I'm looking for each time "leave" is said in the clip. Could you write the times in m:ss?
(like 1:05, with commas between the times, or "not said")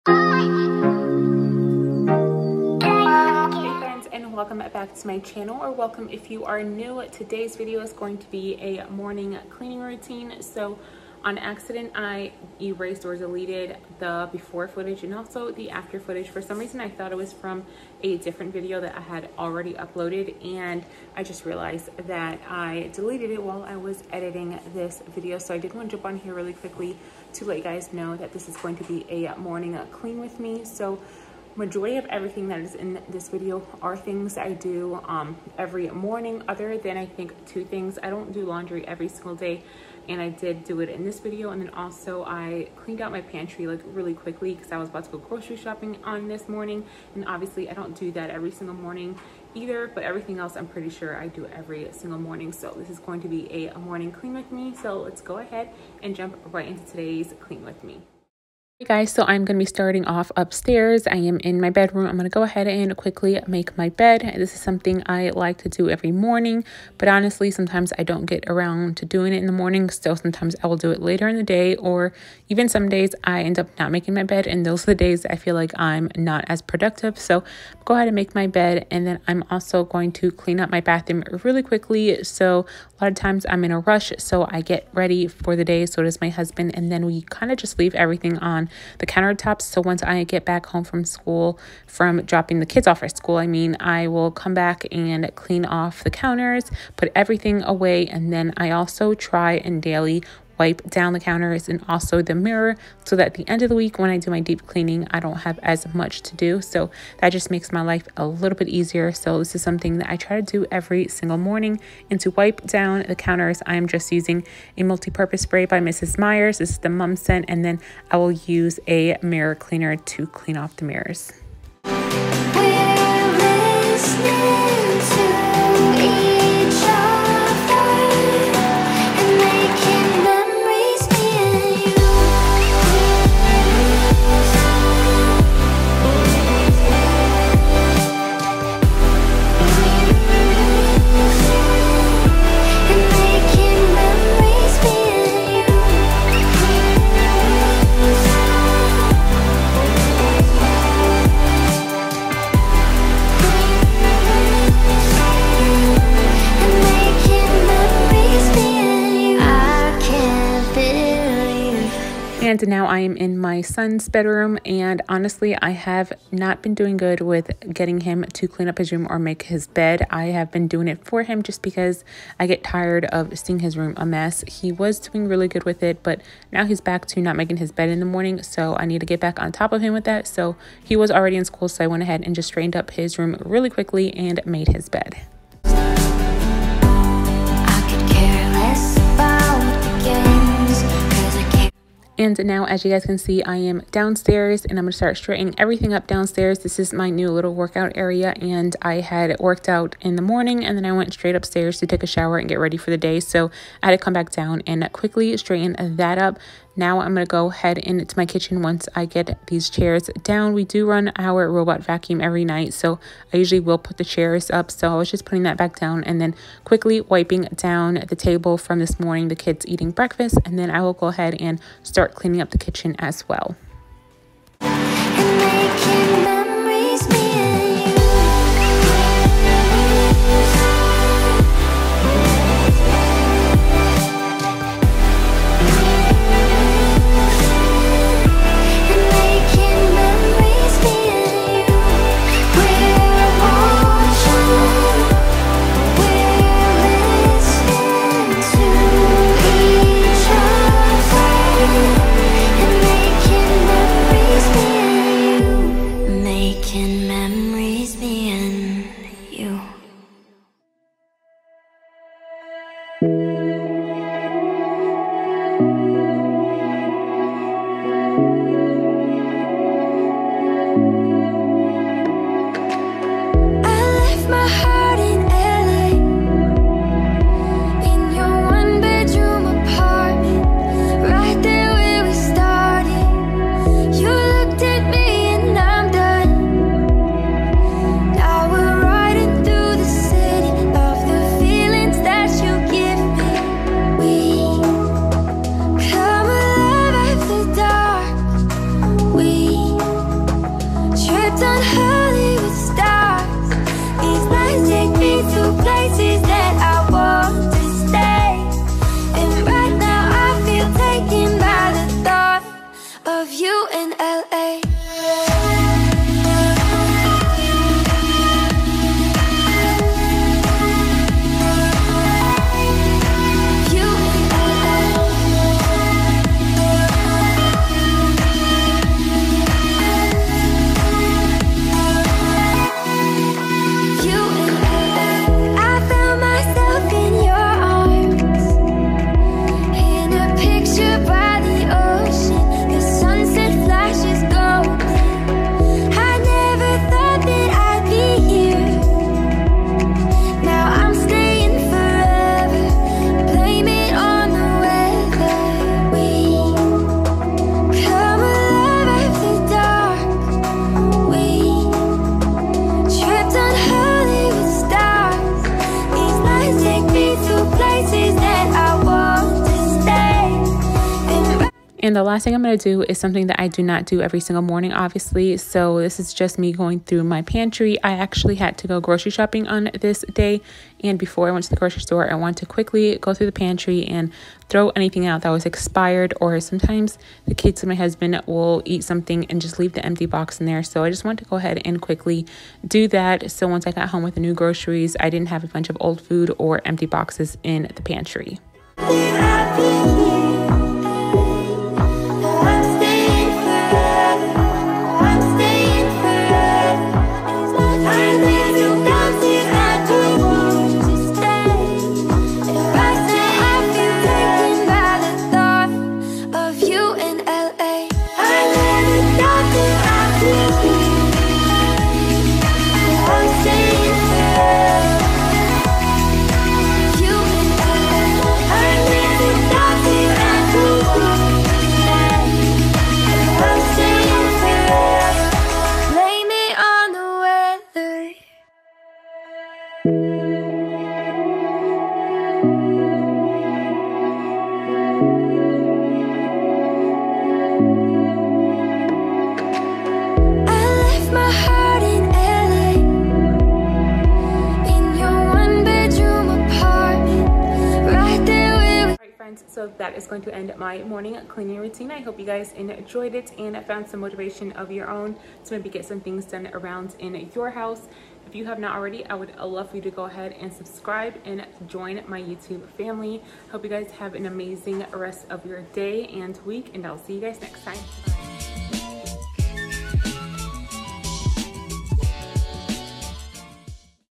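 1:27, 6:29.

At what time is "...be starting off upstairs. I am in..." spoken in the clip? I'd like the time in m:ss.
0:59.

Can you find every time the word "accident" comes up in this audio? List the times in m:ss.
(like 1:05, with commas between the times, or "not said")
0:11.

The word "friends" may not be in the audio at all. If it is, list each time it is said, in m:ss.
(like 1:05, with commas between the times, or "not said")
7:39.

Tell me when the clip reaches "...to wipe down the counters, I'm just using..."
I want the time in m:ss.
1:52.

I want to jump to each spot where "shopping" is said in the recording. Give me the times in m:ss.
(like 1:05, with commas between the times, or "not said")
0:45, 6:19.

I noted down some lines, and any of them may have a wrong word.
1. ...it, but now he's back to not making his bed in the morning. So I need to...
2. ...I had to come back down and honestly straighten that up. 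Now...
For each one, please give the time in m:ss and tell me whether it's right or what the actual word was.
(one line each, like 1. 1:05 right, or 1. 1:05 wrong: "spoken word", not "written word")
1. 2:55 right
2. 3:23 wrong: "quickly", not "honestly".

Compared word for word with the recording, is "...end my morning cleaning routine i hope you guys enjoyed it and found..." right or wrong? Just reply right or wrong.
right.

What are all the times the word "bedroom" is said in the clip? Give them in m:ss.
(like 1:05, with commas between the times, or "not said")
1:01, 2:44.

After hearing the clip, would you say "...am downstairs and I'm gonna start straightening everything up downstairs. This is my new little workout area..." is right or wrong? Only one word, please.
right.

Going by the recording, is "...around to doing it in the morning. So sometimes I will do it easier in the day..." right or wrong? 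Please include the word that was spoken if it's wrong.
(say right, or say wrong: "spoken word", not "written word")
wrong: "later", not "easier".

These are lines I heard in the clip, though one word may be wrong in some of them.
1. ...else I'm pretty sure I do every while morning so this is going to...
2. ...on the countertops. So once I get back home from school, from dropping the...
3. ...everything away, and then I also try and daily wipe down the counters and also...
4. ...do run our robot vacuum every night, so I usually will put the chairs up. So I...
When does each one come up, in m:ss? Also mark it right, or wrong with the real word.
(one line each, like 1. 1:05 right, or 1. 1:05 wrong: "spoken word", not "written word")
1. 0:50 wrong: "single", not "while"
2. 1:28 right
3. 1:37 right
4. 3:30 right.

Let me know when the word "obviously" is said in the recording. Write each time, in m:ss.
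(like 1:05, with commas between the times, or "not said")
0:47, 6:14.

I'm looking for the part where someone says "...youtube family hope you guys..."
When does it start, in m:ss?
7:52.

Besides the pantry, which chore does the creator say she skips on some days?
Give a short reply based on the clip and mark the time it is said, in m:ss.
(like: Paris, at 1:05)
laundry, at 0:38.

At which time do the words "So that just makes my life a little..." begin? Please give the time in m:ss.
1:46.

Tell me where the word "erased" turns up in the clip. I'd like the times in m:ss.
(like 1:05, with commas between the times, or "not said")
0:12.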